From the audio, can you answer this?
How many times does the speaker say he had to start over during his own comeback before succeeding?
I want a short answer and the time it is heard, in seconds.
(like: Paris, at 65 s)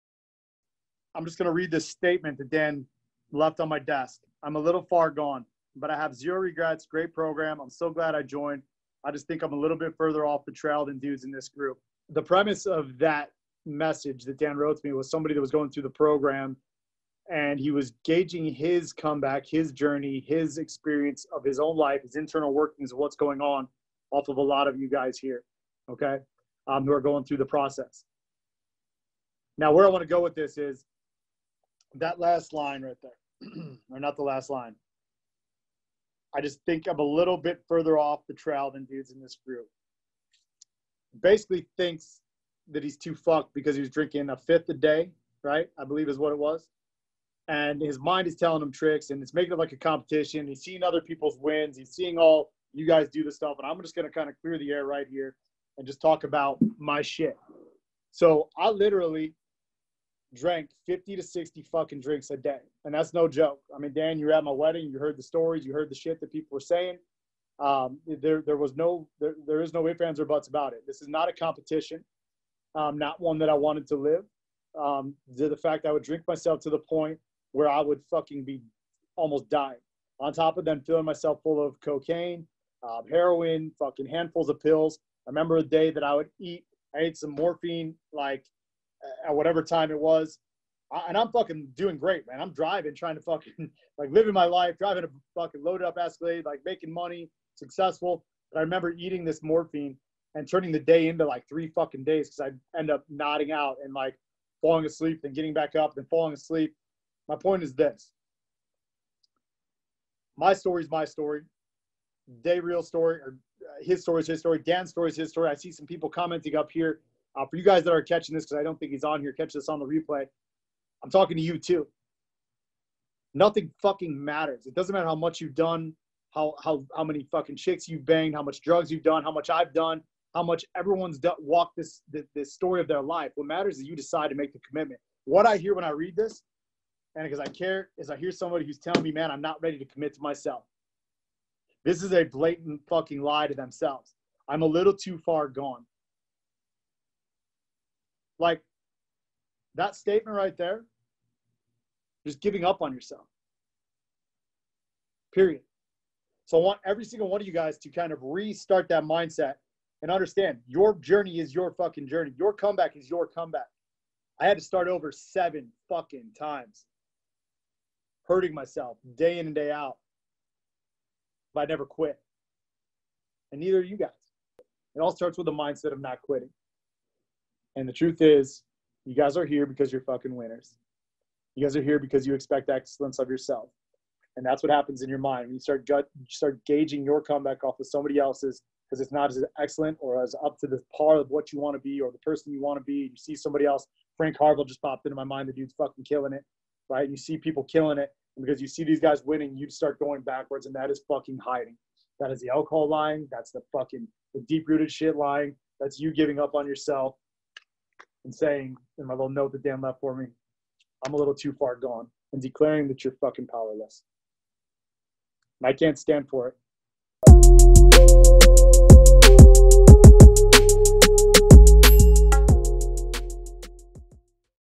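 7, at 165 s.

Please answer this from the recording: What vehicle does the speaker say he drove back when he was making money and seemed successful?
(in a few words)
Escalade.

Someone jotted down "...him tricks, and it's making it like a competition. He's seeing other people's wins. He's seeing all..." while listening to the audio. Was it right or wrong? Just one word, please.
right.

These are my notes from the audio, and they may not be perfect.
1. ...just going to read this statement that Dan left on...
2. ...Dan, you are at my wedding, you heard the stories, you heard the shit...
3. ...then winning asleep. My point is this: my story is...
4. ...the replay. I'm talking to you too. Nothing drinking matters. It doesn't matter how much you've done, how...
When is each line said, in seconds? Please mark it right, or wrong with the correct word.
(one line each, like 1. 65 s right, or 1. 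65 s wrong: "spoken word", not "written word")
1. 1 s right
2. 63 s right
3. 105 s wrong: "falling", not "winning"
4. 119 s wrong: "fucking", not "drinking".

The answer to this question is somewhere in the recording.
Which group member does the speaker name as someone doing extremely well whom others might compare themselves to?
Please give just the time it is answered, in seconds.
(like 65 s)
194 s.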